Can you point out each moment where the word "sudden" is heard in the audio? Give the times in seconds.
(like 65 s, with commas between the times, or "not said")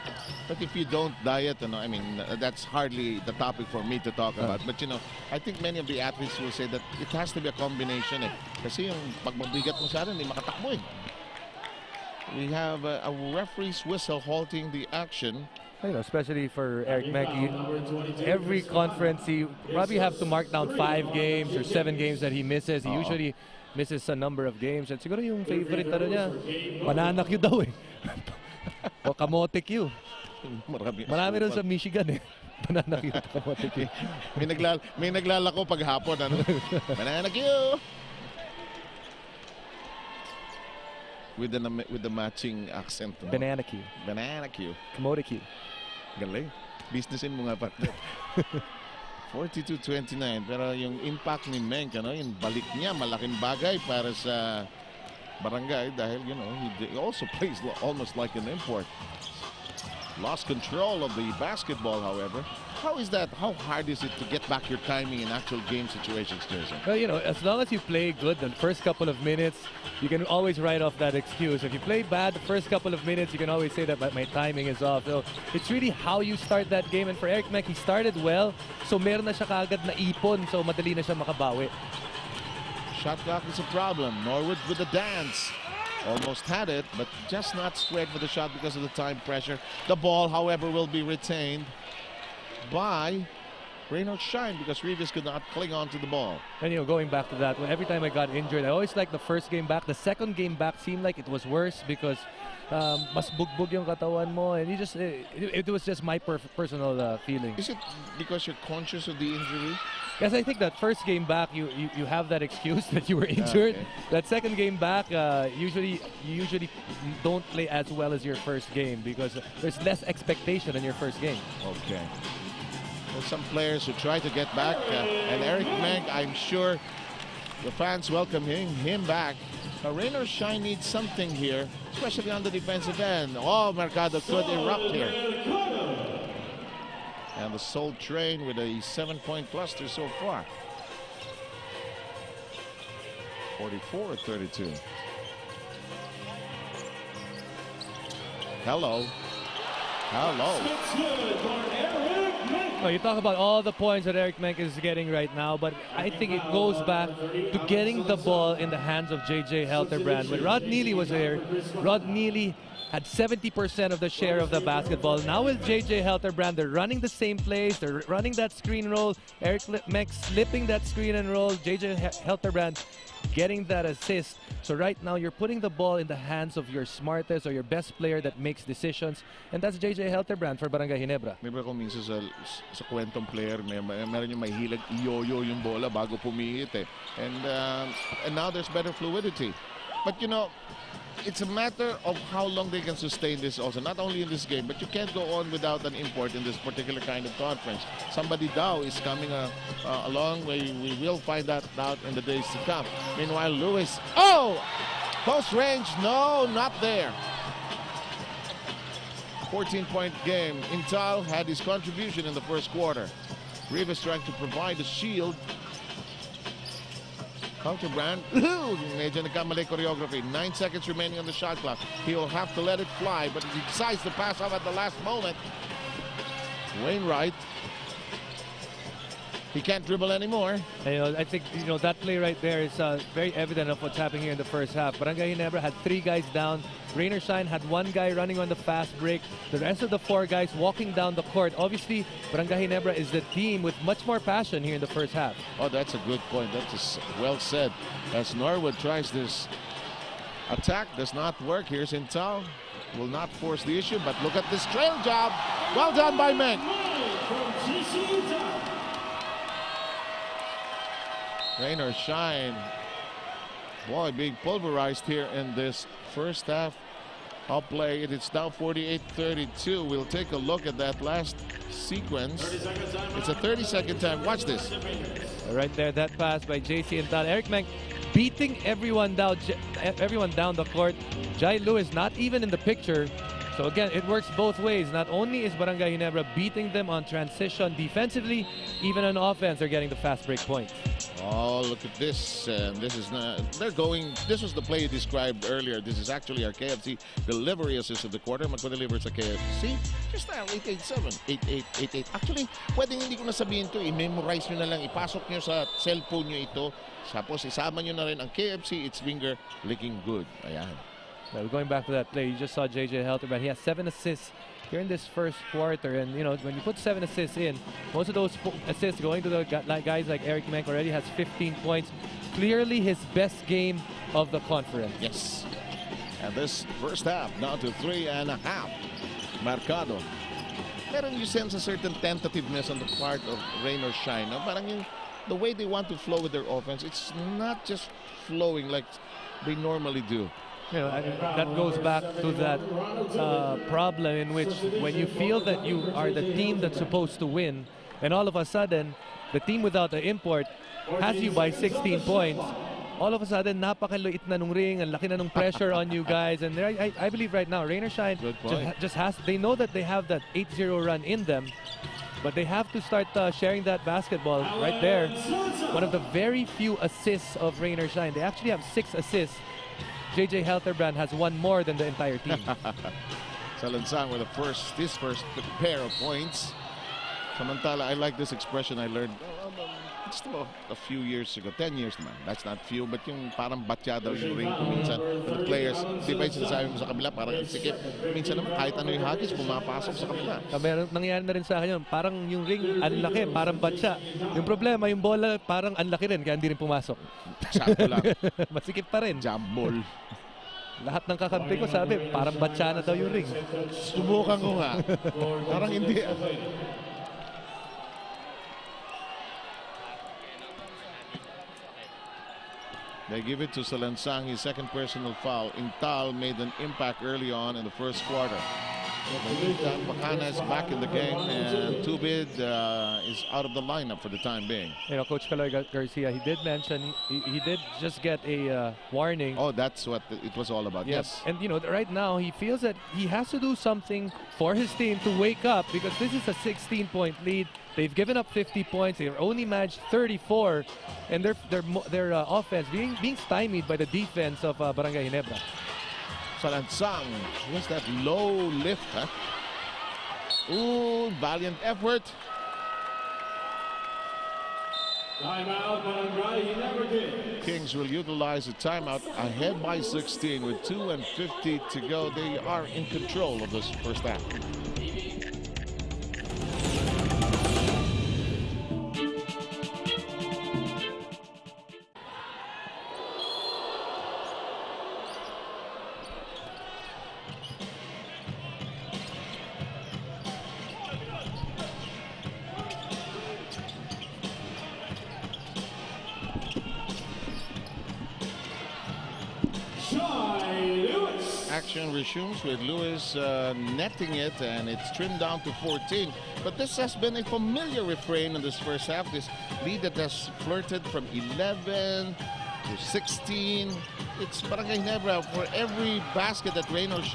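348 s, 353 s.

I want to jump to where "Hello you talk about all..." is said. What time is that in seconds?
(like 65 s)
150 s.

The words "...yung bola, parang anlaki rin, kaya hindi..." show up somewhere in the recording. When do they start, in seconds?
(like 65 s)
394 s.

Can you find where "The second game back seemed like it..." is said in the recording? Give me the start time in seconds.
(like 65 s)
99 s.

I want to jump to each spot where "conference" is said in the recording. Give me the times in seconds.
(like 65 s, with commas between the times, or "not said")
18 s, 197 s, 324 s.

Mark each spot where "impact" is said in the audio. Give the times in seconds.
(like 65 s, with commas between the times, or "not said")
51 s, 416 s.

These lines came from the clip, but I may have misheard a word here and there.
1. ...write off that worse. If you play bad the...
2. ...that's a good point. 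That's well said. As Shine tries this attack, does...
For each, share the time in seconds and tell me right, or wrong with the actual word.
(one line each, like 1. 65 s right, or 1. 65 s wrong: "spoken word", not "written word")
1. 70 s wrong: "excuse", not "worse"
2. 245 s wrong: "Norwood", not "Shine".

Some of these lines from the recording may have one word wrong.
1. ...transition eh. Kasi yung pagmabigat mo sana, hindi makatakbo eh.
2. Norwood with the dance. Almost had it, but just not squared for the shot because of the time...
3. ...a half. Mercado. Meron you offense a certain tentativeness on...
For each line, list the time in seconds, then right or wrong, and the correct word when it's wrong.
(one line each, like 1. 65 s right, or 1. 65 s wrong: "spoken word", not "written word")
1. 7 s wrong: "combination", not "transition"
2. 84 s right
3. 328 s wrong: "sense", not "offense".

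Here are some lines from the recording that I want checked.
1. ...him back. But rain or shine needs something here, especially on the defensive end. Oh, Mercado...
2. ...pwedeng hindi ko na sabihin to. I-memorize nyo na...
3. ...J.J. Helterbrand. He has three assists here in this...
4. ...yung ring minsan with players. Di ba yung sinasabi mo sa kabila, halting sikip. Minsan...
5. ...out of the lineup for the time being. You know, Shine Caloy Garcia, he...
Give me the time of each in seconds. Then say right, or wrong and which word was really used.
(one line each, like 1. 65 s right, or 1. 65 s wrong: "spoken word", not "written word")
1. 128 s right
2. 302 s right
3. 312 s wrong: "seven", not "three"
4. 384 s wrong: "parang", not "halting"
5. 423 s wrong: "Coach", not "Shine".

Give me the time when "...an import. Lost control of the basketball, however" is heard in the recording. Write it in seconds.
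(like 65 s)
58 s.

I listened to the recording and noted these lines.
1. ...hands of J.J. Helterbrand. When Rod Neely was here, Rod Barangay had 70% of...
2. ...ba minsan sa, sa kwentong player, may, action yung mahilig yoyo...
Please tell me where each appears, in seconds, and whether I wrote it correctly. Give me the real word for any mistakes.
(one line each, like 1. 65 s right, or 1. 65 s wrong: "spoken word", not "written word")
1. 158 s wrong: "Neely", not "Barangay"
2. 181 s wrong: "meron", not "action".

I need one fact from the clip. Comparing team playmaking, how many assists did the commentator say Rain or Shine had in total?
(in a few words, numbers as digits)
6.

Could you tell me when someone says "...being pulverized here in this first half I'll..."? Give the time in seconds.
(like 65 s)
264 s.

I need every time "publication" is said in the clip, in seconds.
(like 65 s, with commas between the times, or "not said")
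not said.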